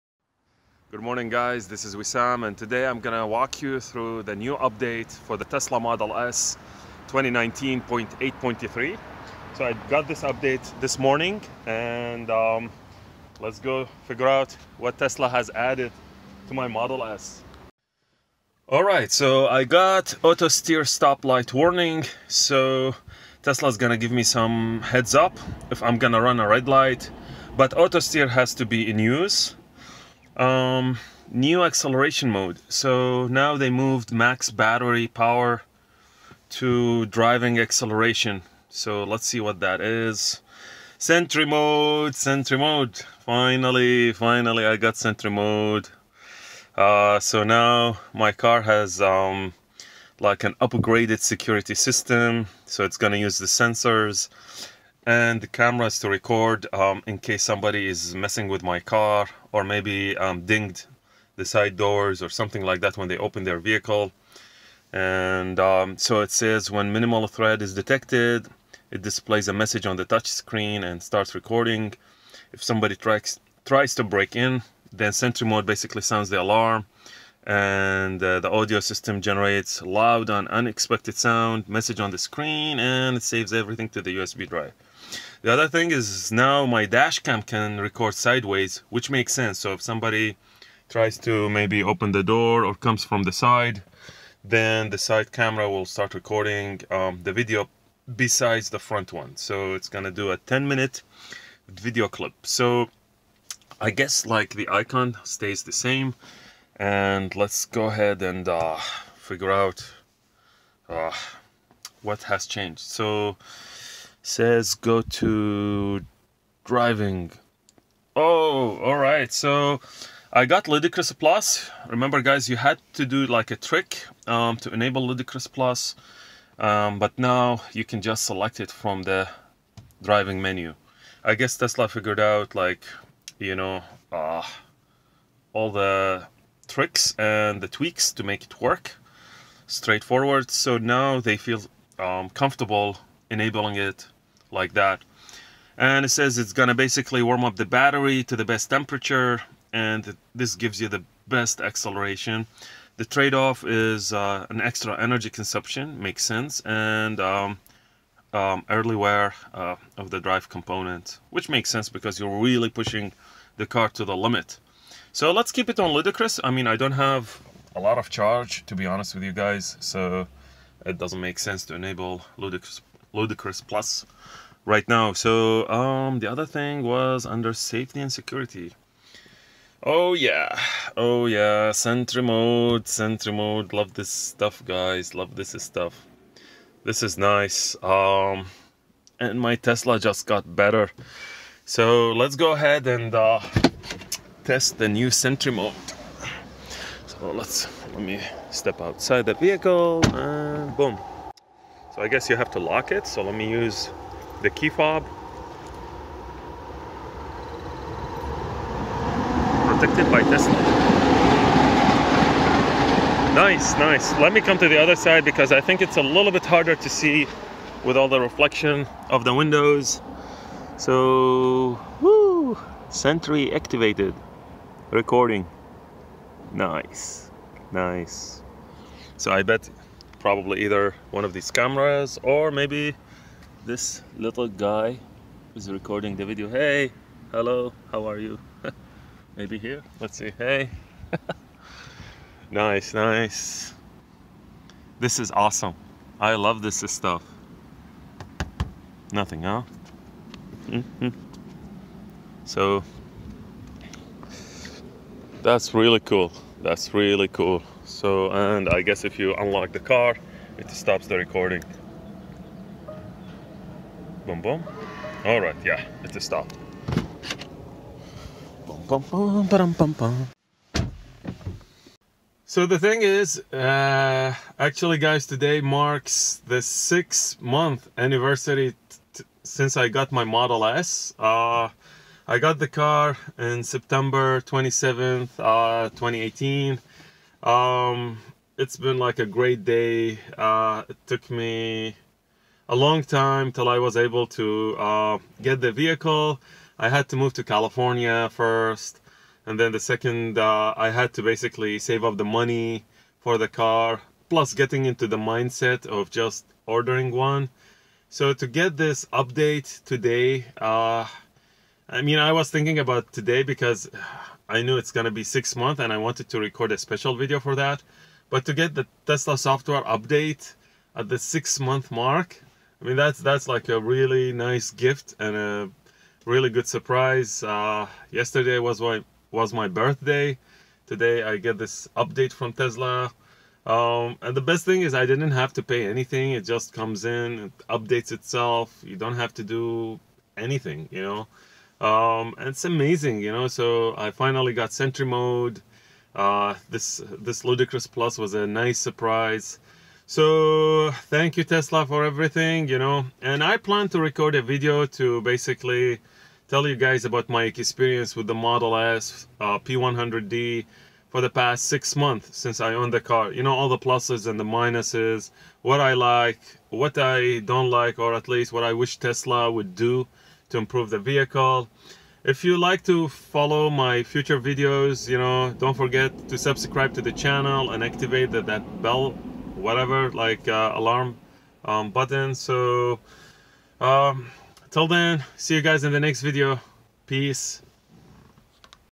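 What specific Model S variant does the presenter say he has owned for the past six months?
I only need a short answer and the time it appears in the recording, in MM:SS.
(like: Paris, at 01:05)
P100D, at 05:59.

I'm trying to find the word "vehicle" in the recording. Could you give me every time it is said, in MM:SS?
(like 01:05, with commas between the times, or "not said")
01:03, 03:19, 04:55, 06:10.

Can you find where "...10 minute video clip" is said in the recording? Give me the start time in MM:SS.
01:40.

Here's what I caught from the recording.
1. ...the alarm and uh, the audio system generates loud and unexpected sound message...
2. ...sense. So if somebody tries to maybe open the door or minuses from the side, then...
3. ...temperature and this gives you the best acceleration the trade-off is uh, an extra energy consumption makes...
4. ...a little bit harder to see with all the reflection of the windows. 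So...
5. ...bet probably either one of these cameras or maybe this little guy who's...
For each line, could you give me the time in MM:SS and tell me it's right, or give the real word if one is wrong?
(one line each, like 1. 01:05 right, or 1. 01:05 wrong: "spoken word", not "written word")
1. 01:16 right
2. 01:29 wrong: "comes", not "minuses"
3. 02:28 right
4. 03:35 right
5. 03:49 right.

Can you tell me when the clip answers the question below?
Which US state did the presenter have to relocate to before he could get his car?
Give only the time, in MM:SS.
04:57.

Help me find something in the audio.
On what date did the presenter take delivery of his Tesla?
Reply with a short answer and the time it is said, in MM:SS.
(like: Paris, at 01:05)
September 27, 2018, at 04:43.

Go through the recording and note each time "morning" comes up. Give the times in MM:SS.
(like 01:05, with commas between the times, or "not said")
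00:01, 00:10.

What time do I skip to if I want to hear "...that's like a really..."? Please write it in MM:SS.
05:23.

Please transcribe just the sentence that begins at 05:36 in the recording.
It just comes in, it updates itself.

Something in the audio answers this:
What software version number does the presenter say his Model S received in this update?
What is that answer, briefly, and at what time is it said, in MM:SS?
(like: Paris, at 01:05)
2019.8.3, at 00:07.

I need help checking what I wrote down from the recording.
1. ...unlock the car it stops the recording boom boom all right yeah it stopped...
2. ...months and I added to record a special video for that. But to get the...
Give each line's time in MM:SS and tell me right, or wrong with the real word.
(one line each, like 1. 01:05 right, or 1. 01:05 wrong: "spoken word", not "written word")
1. 04:19 right
2. 05:15 wrong: "wanted", not "added".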